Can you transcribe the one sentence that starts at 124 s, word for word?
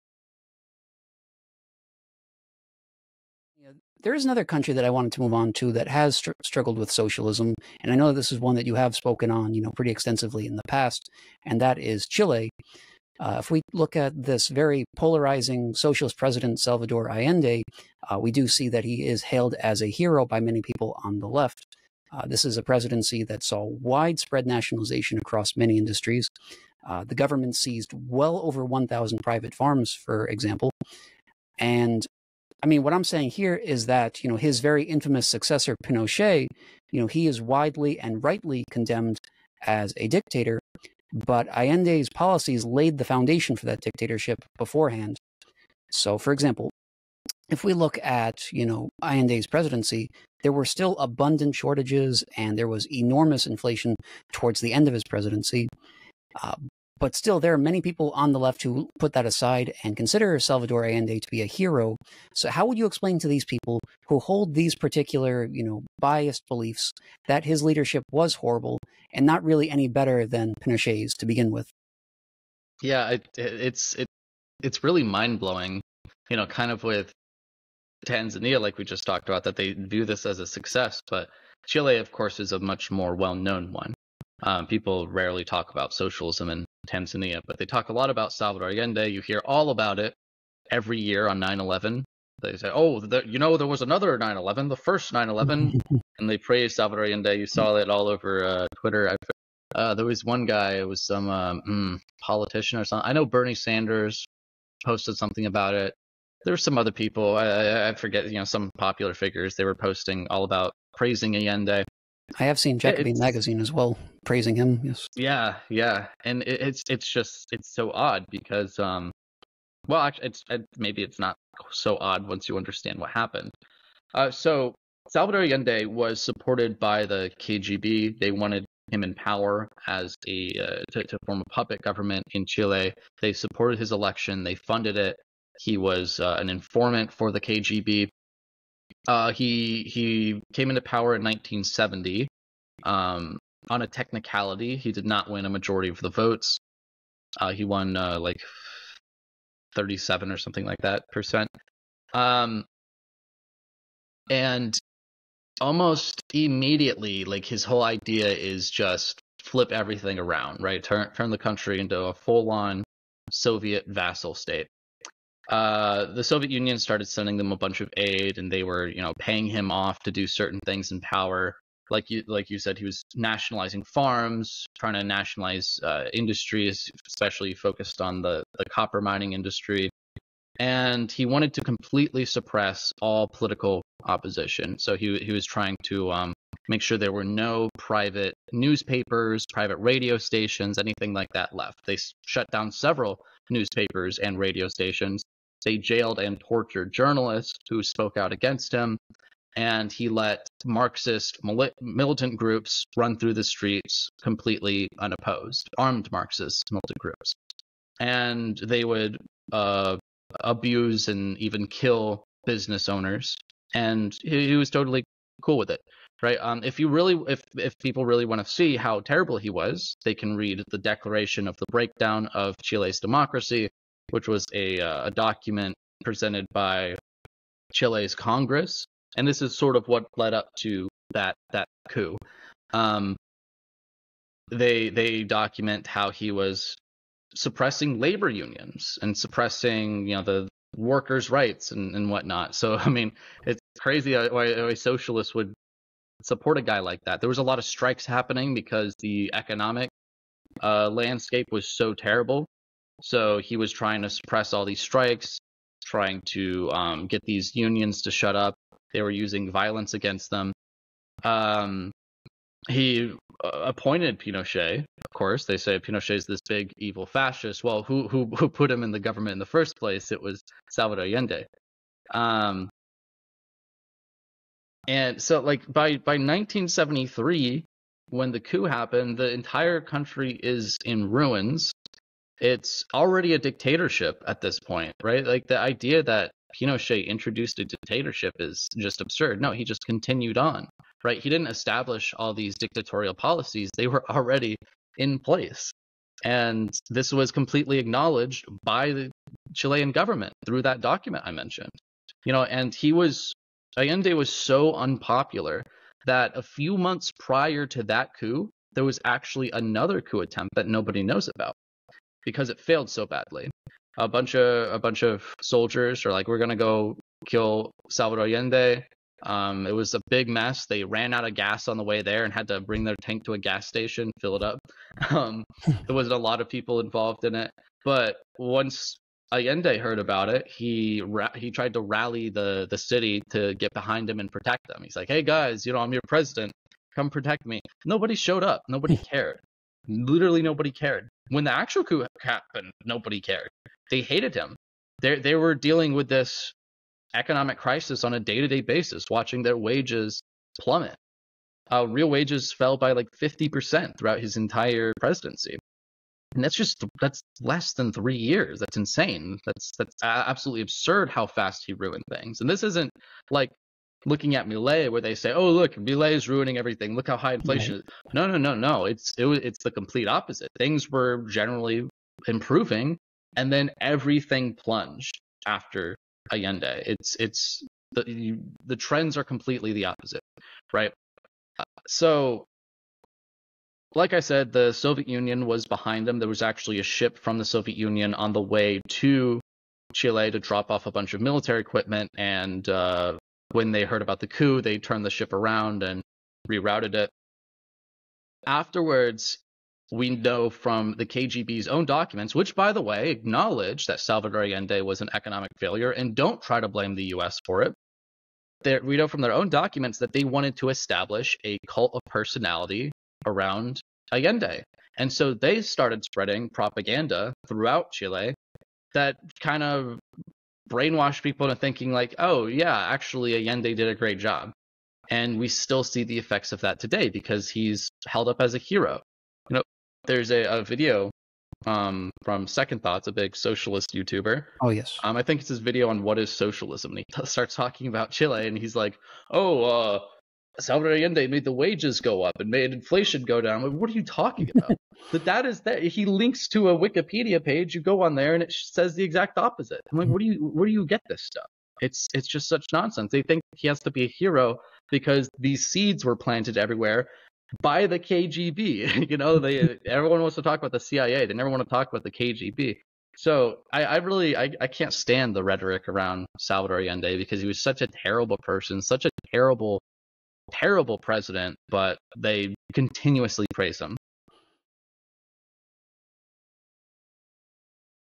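Uh, so Salvador Allende was supported by the KGB.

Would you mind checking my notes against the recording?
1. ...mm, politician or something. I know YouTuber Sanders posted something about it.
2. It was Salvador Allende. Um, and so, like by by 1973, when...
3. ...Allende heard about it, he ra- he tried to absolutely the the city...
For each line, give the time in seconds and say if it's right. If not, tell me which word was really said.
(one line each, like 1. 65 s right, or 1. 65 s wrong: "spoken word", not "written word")
1. 101 s wrong: "Bernie", not "YouTuber"
2. 270 s right
3. 329 s wrong: "rally", not "absolutely".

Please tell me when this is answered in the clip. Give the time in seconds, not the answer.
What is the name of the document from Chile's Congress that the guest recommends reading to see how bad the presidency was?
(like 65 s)
220 s.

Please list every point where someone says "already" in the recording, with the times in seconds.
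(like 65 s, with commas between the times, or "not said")
282 s, 294 s.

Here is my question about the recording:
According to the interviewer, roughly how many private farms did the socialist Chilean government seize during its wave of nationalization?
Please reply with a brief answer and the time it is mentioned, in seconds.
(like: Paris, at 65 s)
over 1,000, at 27 s.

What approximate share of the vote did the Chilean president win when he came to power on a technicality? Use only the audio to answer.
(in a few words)
37%.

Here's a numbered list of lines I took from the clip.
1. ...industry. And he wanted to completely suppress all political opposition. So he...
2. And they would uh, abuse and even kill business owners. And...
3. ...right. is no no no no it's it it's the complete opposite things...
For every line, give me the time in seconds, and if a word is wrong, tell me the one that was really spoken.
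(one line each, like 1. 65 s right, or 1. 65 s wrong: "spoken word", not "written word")
1. 179 s right
2. 207 s right
3. 367 s right.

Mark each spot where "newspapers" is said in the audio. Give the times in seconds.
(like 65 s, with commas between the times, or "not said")
188 s, 193 s.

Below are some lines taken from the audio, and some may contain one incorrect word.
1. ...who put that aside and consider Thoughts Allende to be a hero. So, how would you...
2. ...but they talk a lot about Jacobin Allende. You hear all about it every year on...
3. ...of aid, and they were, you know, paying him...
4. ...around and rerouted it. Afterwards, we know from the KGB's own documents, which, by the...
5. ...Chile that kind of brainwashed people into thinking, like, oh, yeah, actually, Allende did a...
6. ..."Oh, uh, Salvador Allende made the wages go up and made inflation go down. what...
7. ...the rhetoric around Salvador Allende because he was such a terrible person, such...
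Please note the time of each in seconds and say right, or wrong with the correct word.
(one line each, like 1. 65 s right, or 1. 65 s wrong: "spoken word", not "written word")
1. 58 s wrong: "Salvador", not "Thoughts"
2. 87 s wrong: "Salvador", not "Jacobin"
3. 167 s right
4. 395 s right
5. 417 s right
6. 439 s right
7. 465 s right.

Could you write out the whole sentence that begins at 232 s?
Um, they they document how he was suppressing labor unions and suppressing you know the workers' rights and, and whatnot.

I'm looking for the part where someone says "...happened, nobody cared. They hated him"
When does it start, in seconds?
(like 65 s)
342 s.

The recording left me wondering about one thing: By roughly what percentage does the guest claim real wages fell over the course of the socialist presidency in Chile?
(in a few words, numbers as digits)
50%.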